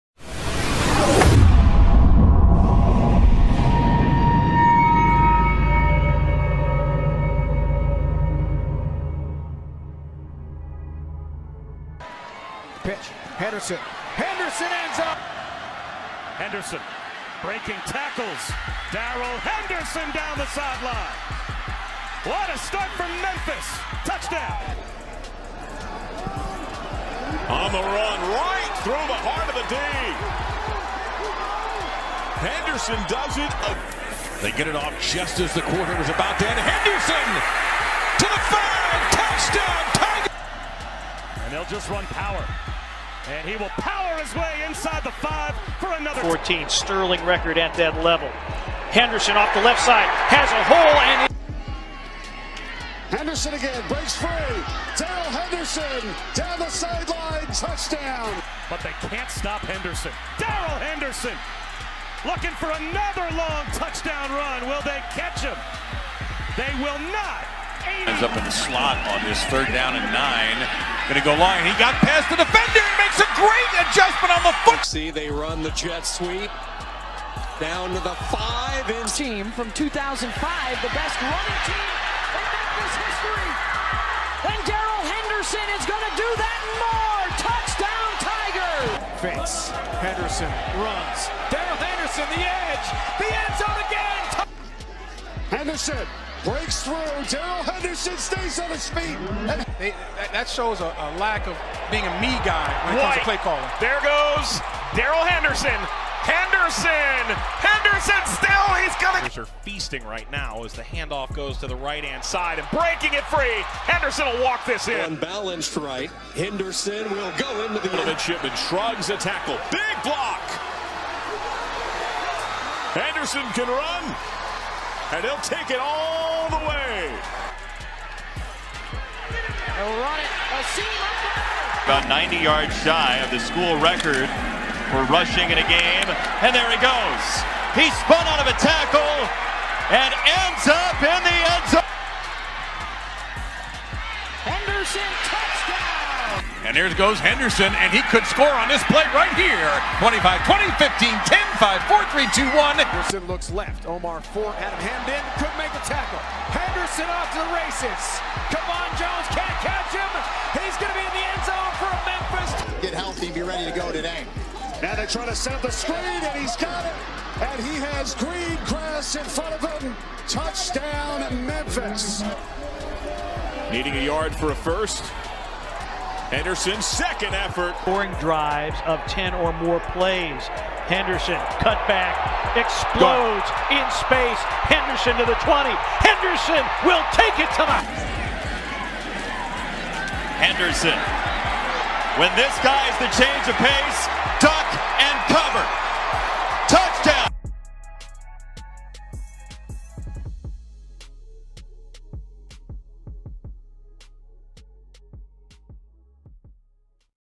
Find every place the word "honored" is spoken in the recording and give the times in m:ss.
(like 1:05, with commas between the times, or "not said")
not said.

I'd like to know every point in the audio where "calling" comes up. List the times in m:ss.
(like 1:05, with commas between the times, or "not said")
1:43.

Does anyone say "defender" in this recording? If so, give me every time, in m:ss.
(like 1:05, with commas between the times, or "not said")
1:12.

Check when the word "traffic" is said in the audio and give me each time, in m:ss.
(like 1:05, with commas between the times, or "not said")
not said.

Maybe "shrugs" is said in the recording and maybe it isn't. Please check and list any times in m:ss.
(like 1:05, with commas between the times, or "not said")
1:58.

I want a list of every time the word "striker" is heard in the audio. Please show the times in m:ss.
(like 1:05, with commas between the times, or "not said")
not said.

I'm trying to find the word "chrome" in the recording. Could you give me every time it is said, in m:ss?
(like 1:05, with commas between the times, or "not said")
not said.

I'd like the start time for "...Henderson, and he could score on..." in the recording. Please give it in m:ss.
2:27.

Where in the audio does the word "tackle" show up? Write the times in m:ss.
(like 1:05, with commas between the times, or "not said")
0:17, 1:59, 2:18, 2:35.